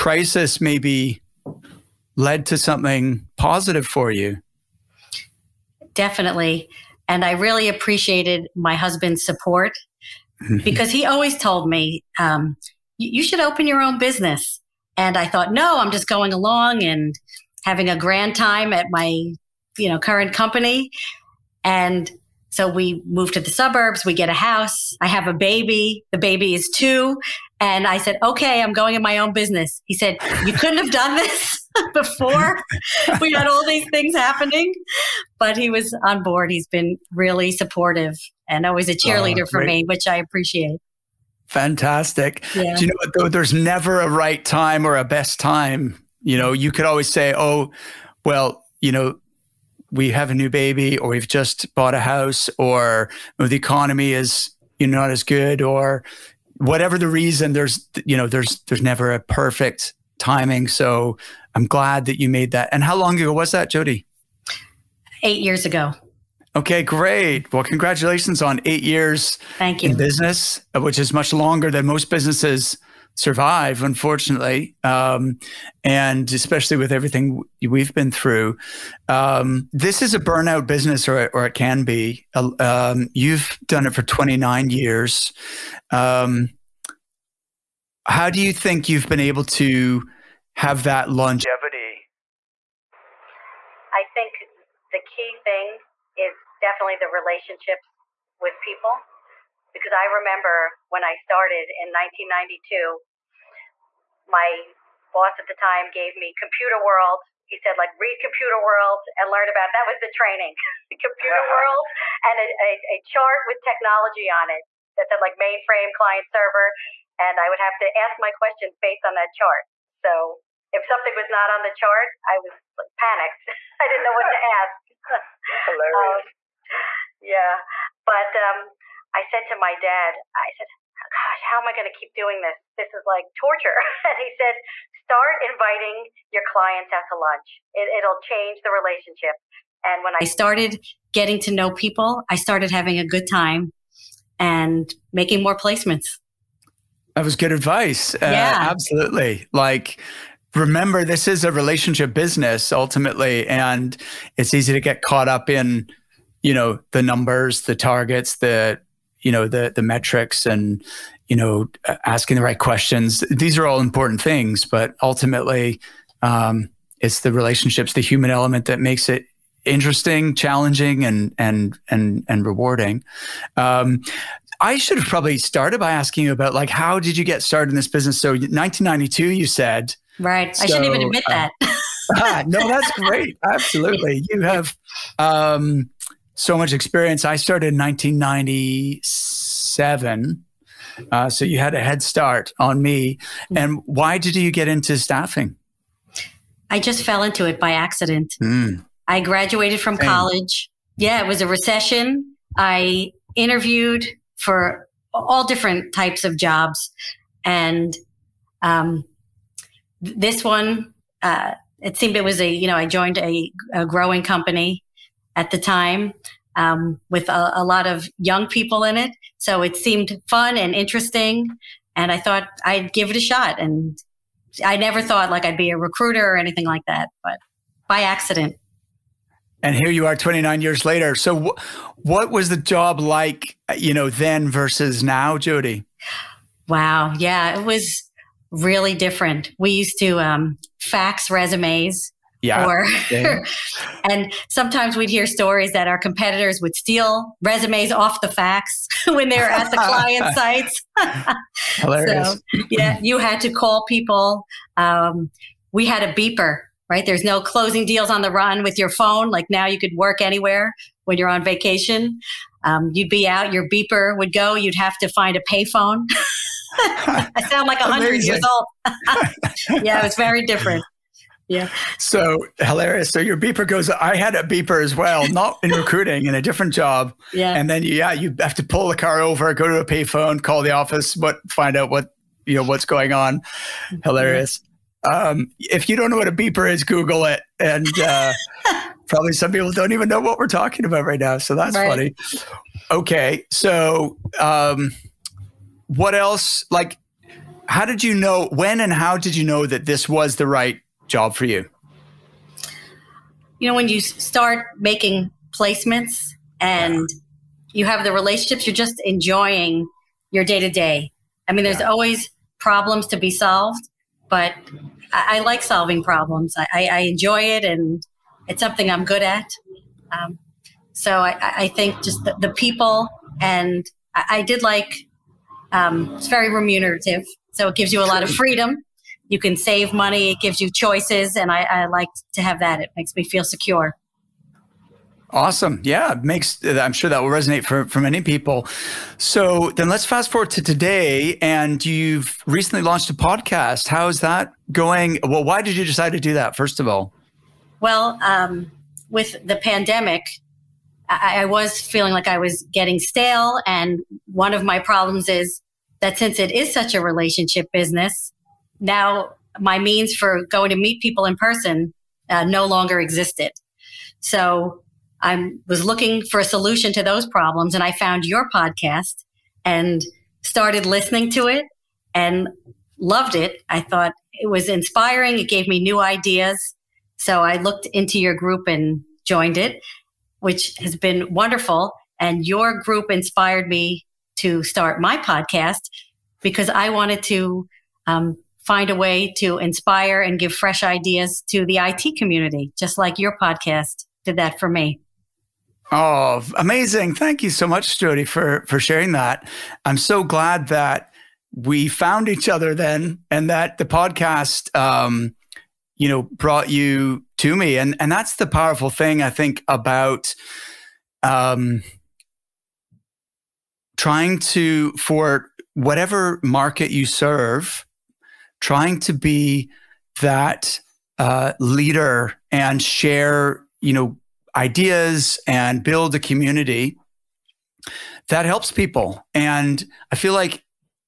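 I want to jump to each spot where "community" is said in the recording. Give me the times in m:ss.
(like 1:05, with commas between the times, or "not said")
6:32, 7:06.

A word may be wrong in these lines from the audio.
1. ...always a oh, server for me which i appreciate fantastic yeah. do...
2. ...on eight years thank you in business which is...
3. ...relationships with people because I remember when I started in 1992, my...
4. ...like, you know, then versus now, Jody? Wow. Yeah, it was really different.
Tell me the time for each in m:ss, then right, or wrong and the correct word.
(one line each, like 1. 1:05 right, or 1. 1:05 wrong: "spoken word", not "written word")
1. 0:38 wrong: "cheerleader", not "server"
2. 1:08 right
3. 1:37 right
4. 3:52 right.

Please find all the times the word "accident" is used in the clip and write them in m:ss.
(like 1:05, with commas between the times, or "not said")
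3:17, 3:48.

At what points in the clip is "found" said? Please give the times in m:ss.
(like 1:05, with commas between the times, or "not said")
6:07, 6:41.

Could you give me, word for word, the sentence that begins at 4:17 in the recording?
There's no closing deals on the run with your phone.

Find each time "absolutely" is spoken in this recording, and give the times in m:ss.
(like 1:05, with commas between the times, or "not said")
2:28, 3:03.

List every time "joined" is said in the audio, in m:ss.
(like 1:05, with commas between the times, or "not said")
3:32, 6:19.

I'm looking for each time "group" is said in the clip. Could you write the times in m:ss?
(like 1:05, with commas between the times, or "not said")
6:18, 6:22.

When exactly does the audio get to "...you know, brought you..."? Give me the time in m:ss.
6:45.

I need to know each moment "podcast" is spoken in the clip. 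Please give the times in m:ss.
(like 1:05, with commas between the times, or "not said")
5:43, 6:08, 6:25, 6:33, 6:43.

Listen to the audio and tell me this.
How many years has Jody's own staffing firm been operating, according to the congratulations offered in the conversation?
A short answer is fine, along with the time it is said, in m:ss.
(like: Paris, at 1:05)
8, at 1:05.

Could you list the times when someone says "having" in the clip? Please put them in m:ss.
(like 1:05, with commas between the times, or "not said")
0:17, 2:22.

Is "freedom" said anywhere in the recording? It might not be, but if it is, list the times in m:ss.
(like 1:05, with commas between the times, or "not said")
5:28.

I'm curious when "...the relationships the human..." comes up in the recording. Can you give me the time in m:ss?
2:47.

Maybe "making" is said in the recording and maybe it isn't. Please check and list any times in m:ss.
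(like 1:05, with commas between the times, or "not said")
2:25, 5:04.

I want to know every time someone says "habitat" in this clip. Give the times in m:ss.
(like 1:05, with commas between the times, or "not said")
not said.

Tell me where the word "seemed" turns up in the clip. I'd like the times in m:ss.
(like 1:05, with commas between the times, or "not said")
3:31, 3:39.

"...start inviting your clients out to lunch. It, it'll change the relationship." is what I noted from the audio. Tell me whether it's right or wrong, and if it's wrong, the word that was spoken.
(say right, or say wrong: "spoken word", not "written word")
right.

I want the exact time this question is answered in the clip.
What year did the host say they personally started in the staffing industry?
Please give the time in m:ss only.
3:07.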